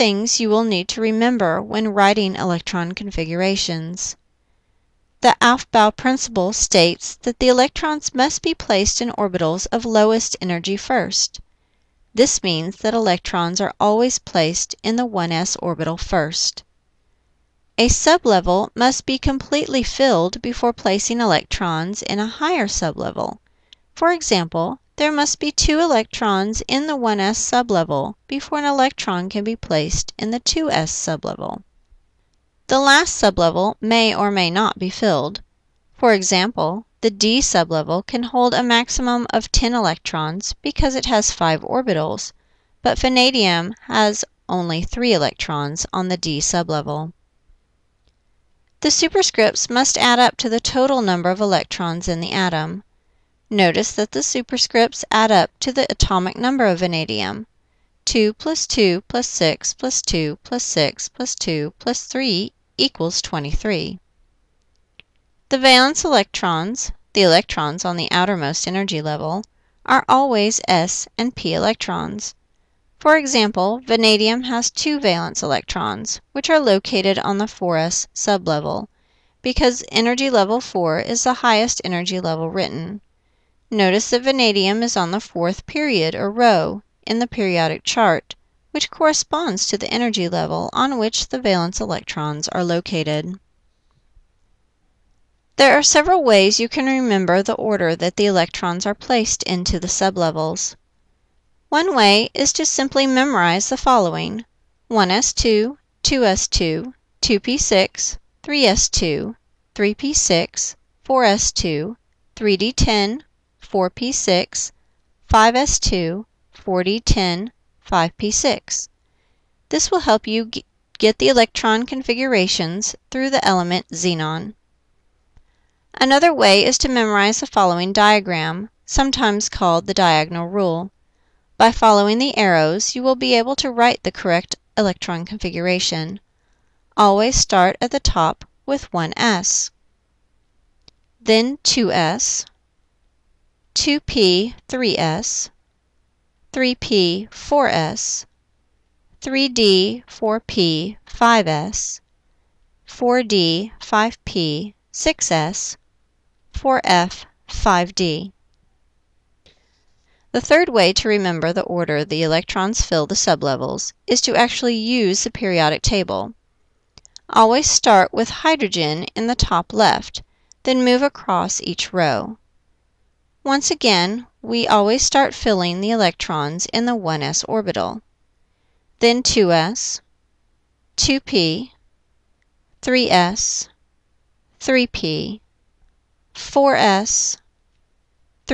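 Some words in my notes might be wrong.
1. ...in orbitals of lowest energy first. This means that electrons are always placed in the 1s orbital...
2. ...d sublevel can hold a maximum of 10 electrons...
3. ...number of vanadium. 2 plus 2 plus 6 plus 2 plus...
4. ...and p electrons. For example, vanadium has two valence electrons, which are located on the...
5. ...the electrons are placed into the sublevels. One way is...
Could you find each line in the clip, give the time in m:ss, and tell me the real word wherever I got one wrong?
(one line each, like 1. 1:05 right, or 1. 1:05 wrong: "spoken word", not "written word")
1. 0:08 right
2. 0:37 right
3. 0:56 right
4. 1:11 right
5. 1:38 right.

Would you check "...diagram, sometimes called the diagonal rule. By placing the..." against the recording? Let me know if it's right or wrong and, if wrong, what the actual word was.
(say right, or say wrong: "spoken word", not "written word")
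wrong: "following", not "placing".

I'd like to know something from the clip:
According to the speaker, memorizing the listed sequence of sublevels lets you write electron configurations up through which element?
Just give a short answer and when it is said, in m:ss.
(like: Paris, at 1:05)
xenon, at 2:03.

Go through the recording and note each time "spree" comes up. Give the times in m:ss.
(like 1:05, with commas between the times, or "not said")
not said.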